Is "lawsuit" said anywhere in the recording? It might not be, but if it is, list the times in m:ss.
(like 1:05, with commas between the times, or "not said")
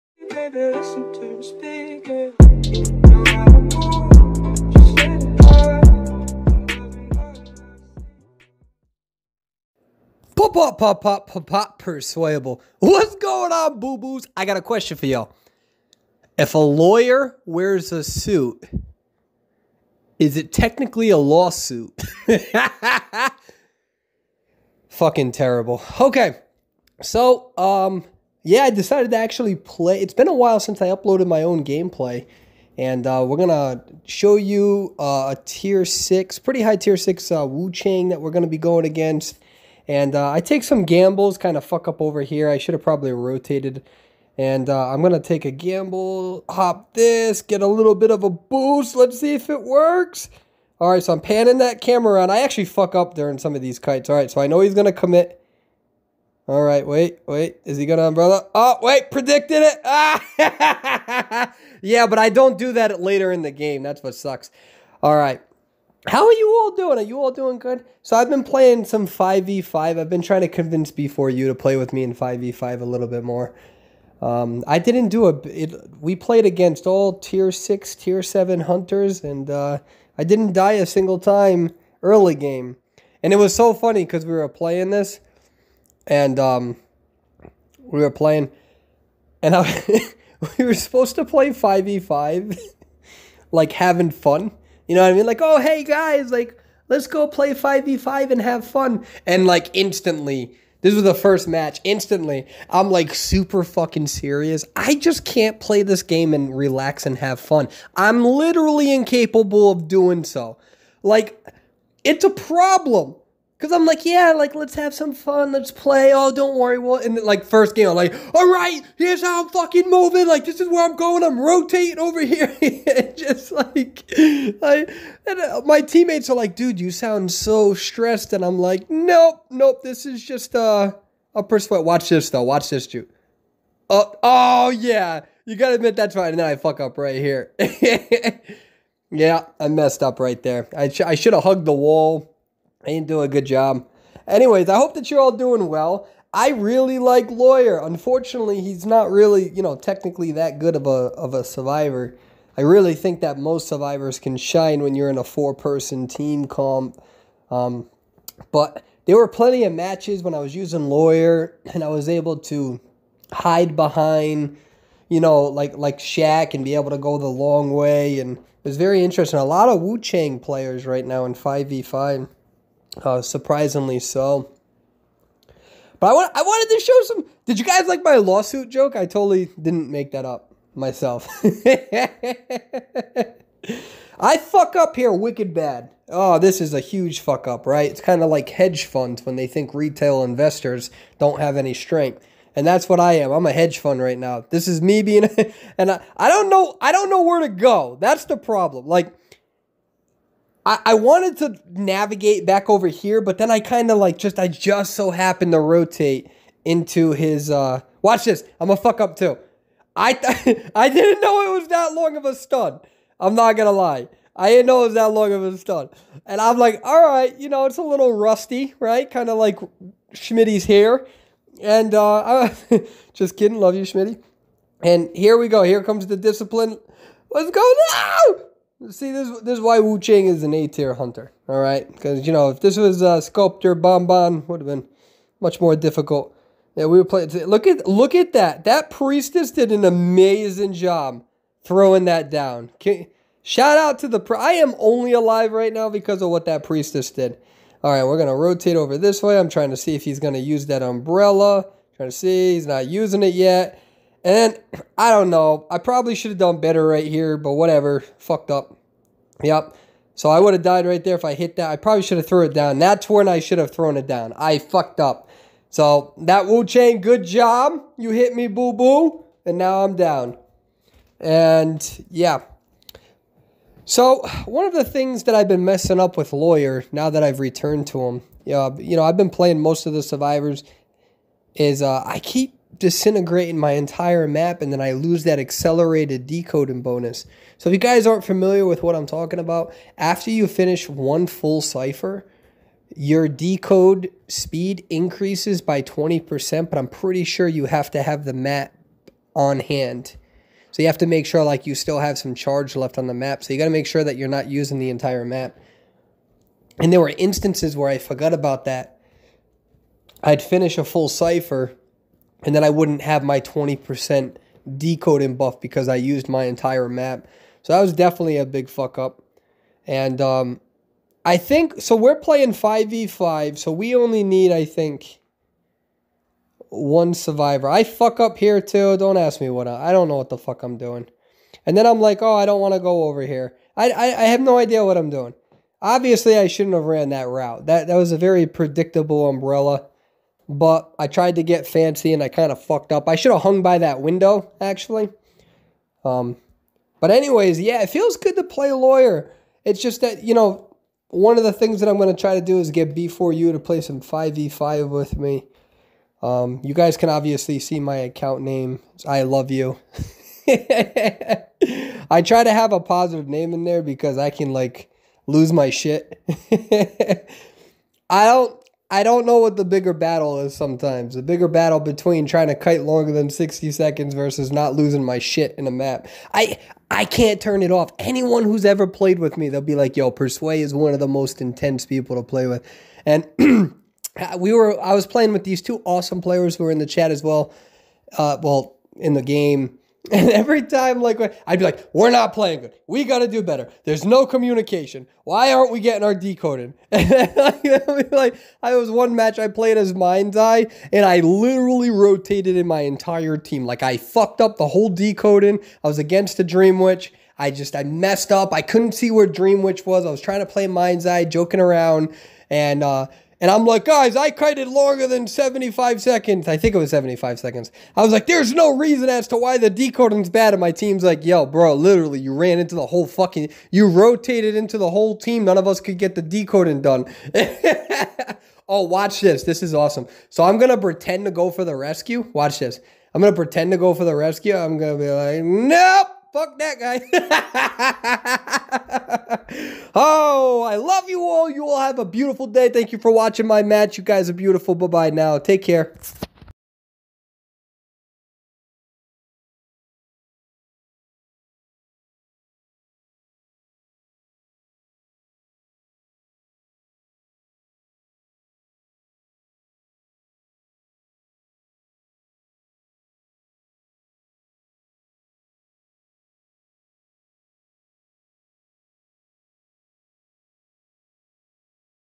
0:21, 2:58.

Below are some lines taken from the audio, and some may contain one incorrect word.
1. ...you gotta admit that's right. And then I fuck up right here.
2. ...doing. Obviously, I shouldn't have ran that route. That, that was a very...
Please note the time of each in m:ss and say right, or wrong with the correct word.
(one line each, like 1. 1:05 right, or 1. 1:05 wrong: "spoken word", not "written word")
1. 2:15 right
2. 5:35 right.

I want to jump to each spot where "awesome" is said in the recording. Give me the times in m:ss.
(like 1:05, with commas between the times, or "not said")
6:25, 7:09.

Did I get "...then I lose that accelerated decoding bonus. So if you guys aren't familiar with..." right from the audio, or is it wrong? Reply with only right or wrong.
right.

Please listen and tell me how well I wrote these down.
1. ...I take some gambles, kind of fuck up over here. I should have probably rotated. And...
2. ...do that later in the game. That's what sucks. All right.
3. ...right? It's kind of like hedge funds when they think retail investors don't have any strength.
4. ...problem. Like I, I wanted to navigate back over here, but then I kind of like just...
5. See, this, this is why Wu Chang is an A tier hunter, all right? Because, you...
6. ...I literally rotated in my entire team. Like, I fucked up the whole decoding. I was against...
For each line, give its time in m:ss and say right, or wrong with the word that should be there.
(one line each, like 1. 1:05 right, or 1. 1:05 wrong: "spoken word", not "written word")
1. 0:40 right
2. 1:02 right
3. 3:07 right
4. 3:18 right
5. 3:48 right
6. 6:41 right.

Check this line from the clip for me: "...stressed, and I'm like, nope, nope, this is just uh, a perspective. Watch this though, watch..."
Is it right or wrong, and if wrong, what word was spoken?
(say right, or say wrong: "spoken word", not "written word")
right.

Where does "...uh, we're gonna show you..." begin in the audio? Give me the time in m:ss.
0:33.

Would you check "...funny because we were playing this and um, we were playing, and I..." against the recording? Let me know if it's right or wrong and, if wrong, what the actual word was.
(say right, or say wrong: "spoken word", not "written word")
right.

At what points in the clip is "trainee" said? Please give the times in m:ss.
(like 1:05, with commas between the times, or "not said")
not said.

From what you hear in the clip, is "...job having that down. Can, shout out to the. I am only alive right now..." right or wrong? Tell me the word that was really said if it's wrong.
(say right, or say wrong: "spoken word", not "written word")
wrong: "throwing", not "having".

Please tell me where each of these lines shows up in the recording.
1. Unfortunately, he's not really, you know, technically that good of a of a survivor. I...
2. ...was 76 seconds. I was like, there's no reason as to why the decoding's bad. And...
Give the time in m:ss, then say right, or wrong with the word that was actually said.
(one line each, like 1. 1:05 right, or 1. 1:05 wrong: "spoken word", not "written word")
1. 2:27 right
2. 6:56 wrong: "75", not "76".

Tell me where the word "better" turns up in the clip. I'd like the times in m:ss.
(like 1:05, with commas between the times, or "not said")
4:16, 6:33.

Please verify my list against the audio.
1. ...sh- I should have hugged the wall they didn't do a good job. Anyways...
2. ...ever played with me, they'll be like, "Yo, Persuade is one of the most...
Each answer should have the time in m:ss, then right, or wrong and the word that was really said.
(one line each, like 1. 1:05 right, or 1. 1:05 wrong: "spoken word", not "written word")
1. 2:20 right
2. 6:18 right.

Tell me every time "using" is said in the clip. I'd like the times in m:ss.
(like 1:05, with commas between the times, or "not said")
2:40, 4:12, 5:04.